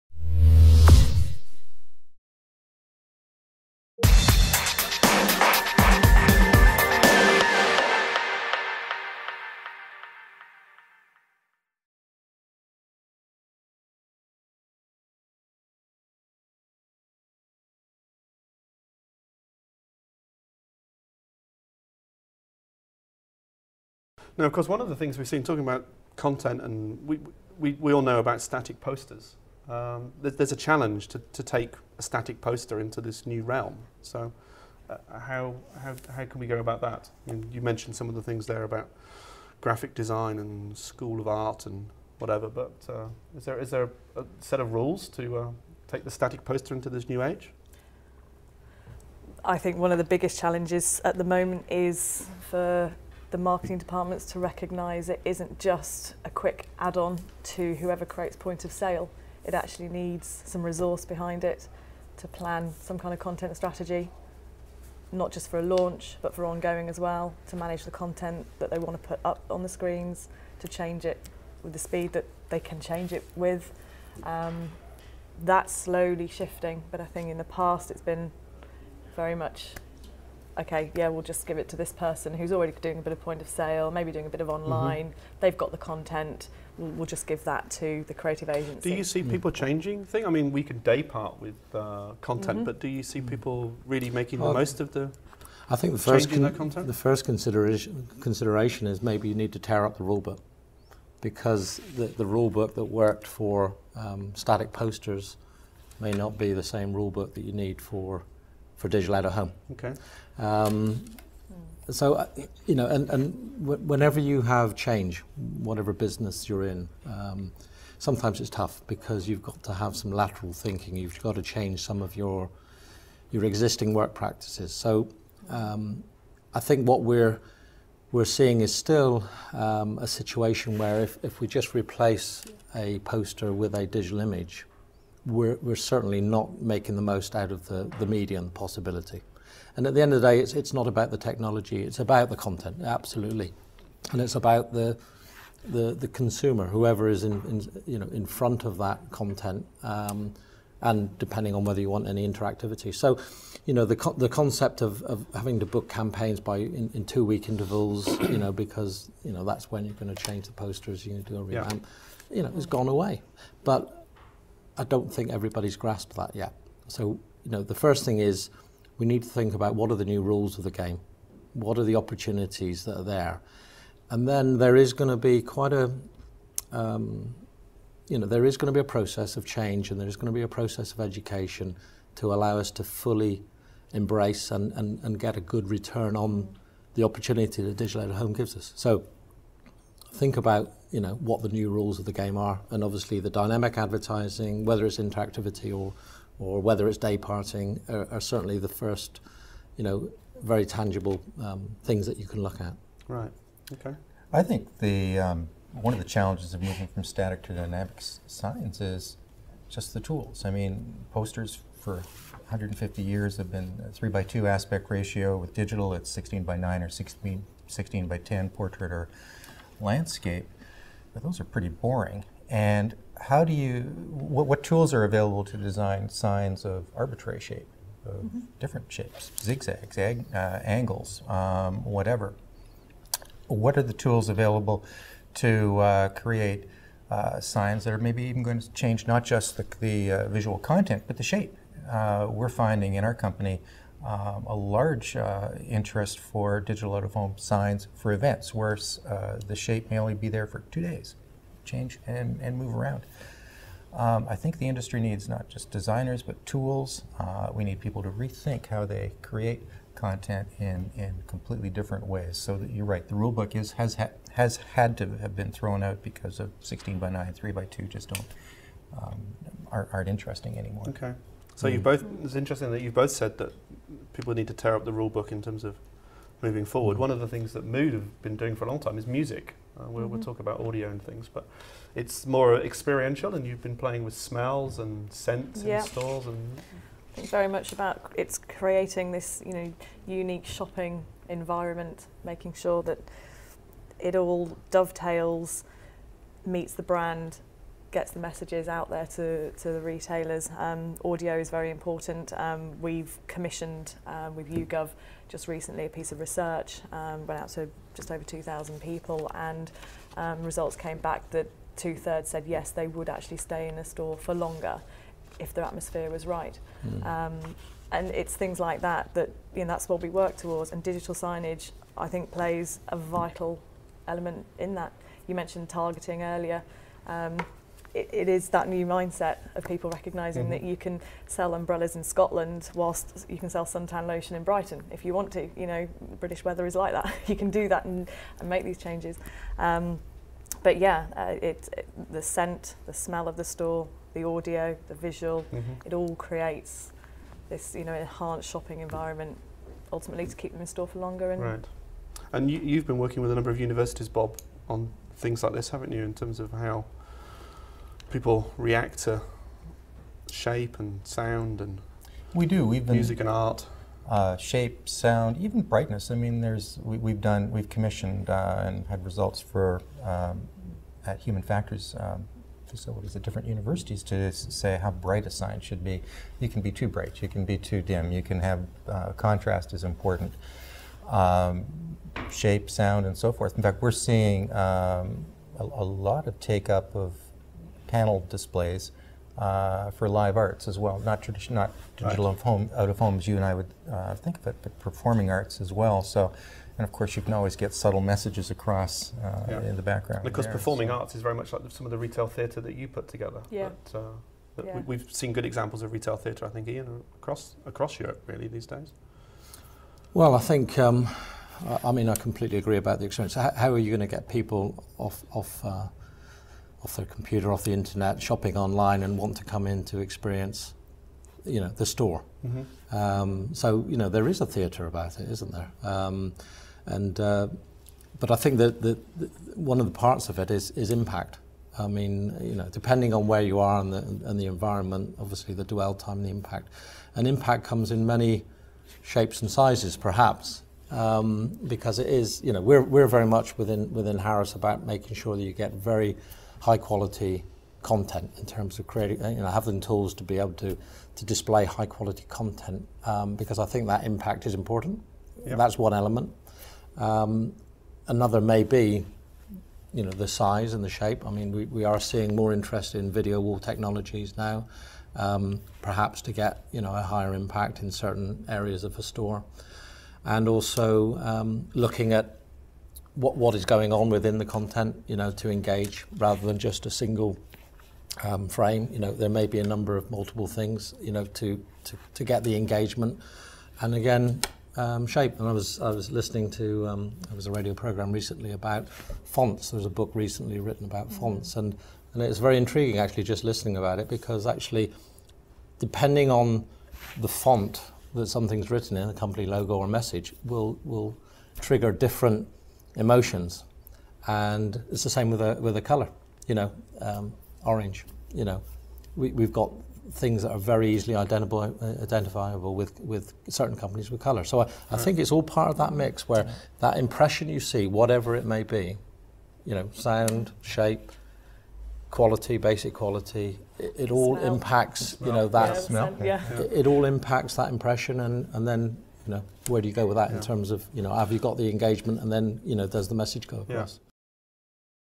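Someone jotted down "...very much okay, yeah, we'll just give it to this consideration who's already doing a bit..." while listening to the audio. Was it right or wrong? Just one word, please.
wrong.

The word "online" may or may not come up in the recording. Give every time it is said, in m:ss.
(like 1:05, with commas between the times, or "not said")
1:24, 6:58.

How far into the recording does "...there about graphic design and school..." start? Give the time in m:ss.
0:38.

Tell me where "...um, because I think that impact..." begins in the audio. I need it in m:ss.
7:33.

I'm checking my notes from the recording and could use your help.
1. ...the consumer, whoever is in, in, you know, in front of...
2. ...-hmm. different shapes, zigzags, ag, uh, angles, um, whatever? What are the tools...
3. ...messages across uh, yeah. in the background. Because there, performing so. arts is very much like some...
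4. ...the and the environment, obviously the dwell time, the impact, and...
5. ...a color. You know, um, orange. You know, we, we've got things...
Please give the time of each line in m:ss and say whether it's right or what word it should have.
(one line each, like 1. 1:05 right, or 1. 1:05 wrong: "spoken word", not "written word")
1. 2:25 right
2. 3:48 right
3. 6:38 right
4. 7:13 right
5. 8:25 right.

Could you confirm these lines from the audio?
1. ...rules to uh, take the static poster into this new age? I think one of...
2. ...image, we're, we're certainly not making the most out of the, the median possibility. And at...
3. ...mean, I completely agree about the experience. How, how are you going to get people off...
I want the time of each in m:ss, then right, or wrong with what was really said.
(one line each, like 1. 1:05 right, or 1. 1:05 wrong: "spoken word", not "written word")
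1. 0:44 right
2. 2:14 right
3. 6:51 right.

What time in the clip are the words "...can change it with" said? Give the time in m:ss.
1:12.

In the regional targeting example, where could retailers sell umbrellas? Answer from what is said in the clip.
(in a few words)
Scotland.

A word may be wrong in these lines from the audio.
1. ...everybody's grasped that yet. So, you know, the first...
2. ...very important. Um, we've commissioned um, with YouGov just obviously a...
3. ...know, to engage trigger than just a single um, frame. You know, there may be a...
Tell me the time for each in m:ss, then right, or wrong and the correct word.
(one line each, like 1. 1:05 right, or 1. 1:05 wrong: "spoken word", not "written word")
1. 2:45 right
2. 5:01 wrong: "recently", not "obviously"
3. 7:55 wrong: "rather", not "trigger".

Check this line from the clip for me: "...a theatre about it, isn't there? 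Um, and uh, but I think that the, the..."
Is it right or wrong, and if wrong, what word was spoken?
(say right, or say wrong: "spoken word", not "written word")
right.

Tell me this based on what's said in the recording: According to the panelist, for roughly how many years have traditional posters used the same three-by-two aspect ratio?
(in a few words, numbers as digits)
150.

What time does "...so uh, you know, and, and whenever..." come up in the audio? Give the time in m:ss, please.
1:51.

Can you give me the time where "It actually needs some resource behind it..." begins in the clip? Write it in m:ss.
0:59.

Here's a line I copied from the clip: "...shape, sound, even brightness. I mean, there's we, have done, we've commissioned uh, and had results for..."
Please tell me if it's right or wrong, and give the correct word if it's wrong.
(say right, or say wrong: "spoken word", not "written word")
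right.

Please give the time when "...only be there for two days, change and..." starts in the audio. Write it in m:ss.
4:09.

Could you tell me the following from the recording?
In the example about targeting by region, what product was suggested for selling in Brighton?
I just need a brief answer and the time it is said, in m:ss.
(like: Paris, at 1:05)
suntan lotion, at 5:33.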